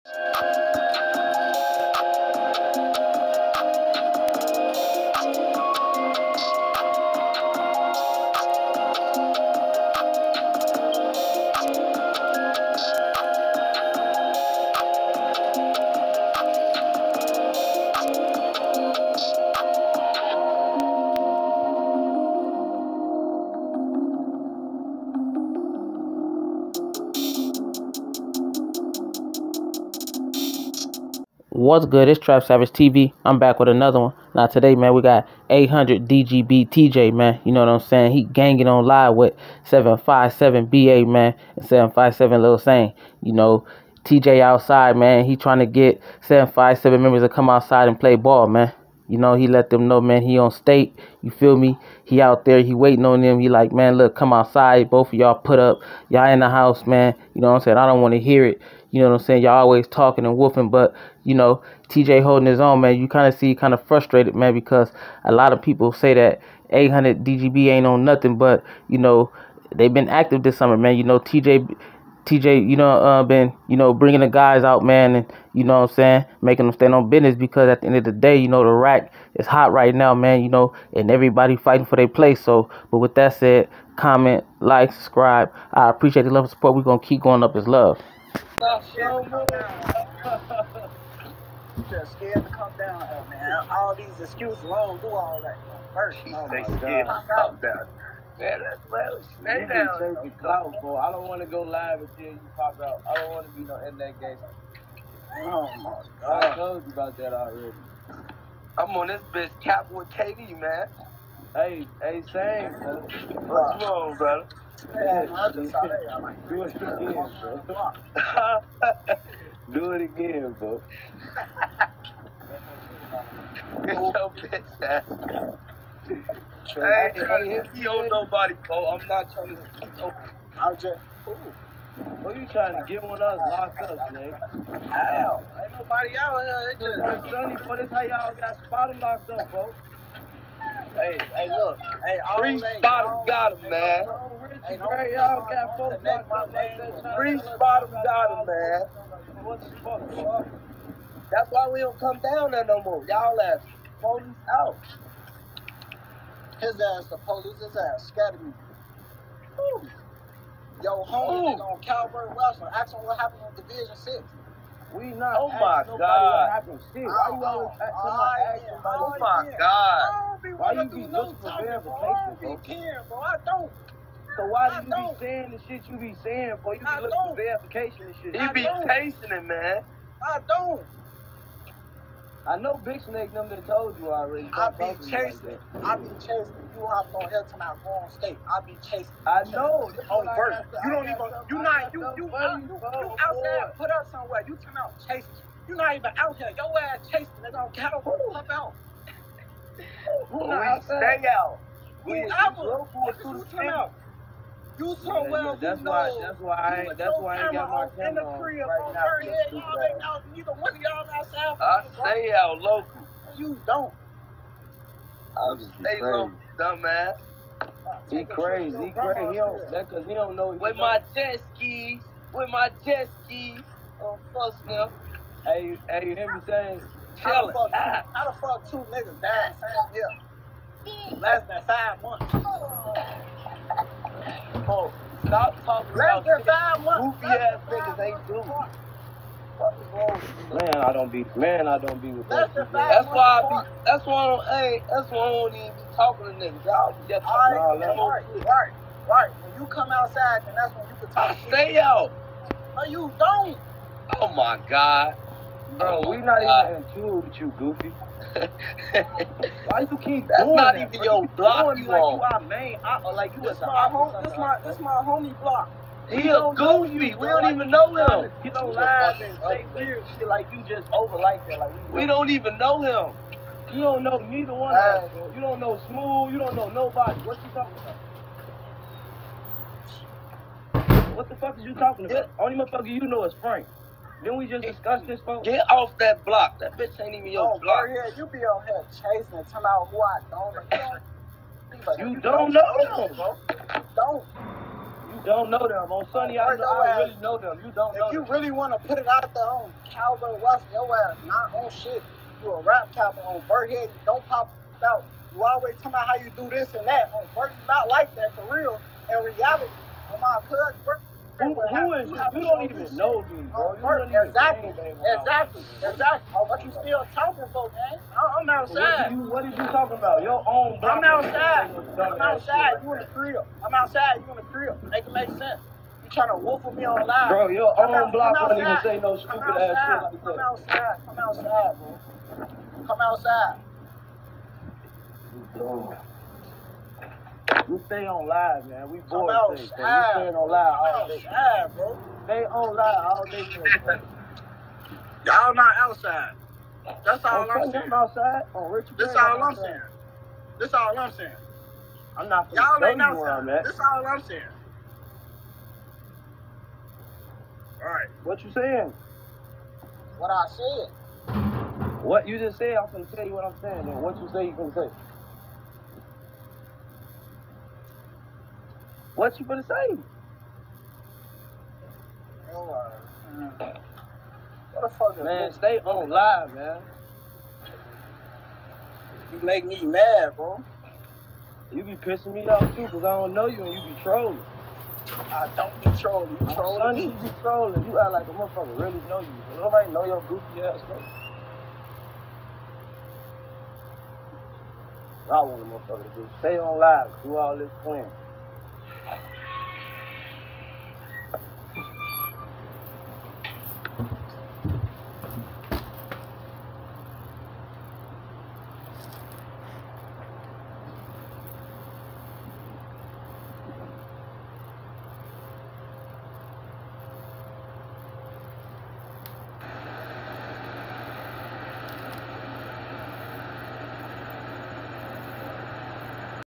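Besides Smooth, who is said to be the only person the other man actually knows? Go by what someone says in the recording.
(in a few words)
Frank.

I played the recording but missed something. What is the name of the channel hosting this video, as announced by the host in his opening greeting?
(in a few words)
Trap Savage TV.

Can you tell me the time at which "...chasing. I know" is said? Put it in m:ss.
3:08.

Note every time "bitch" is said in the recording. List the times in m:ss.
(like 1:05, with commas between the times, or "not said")
1:49, 2:04, 4:46.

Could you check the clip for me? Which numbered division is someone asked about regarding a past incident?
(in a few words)
Division 6.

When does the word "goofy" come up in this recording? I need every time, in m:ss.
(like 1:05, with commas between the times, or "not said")
4:17, 4:26, 6:30.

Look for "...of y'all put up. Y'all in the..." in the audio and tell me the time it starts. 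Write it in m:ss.
0:55.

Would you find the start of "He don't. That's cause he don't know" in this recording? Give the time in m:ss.
3:38.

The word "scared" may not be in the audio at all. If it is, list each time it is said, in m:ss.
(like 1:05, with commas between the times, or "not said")
1:32, 1:36.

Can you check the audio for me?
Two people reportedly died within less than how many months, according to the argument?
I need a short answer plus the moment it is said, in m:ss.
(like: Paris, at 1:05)
5, at 3:51.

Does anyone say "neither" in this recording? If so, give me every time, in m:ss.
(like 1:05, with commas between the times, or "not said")
3:30, 4:34.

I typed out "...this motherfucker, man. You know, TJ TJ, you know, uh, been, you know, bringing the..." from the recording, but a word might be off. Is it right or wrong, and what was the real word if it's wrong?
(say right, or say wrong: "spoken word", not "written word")
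wrong: "summer", not "motherfucker".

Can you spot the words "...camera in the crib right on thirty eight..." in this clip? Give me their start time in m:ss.
3:27.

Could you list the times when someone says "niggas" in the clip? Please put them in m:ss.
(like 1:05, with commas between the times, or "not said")
3:48, 4:06.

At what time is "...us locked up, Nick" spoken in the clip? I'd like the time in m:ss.
2:13.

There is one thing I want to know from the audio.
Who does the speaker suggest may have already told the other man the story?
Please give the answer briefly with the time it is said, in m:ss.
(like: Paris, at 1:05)
Big Snake, at 3:02.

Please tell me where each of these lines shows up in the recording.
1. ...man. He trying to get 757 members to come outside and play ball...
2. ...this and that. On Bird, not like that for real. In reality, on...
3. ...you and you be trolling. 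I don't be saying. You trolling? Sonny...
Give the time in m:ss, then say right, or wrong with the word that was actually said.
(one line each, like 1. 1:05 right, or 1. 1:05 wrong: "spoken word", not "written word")
1. 0:44 right
2. 5:06 right
3. 6:23 wrong: "trolling", not "saying".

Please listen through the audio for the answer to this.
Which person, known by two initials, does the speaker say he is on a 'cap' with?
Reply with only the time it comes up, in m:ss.
1:50.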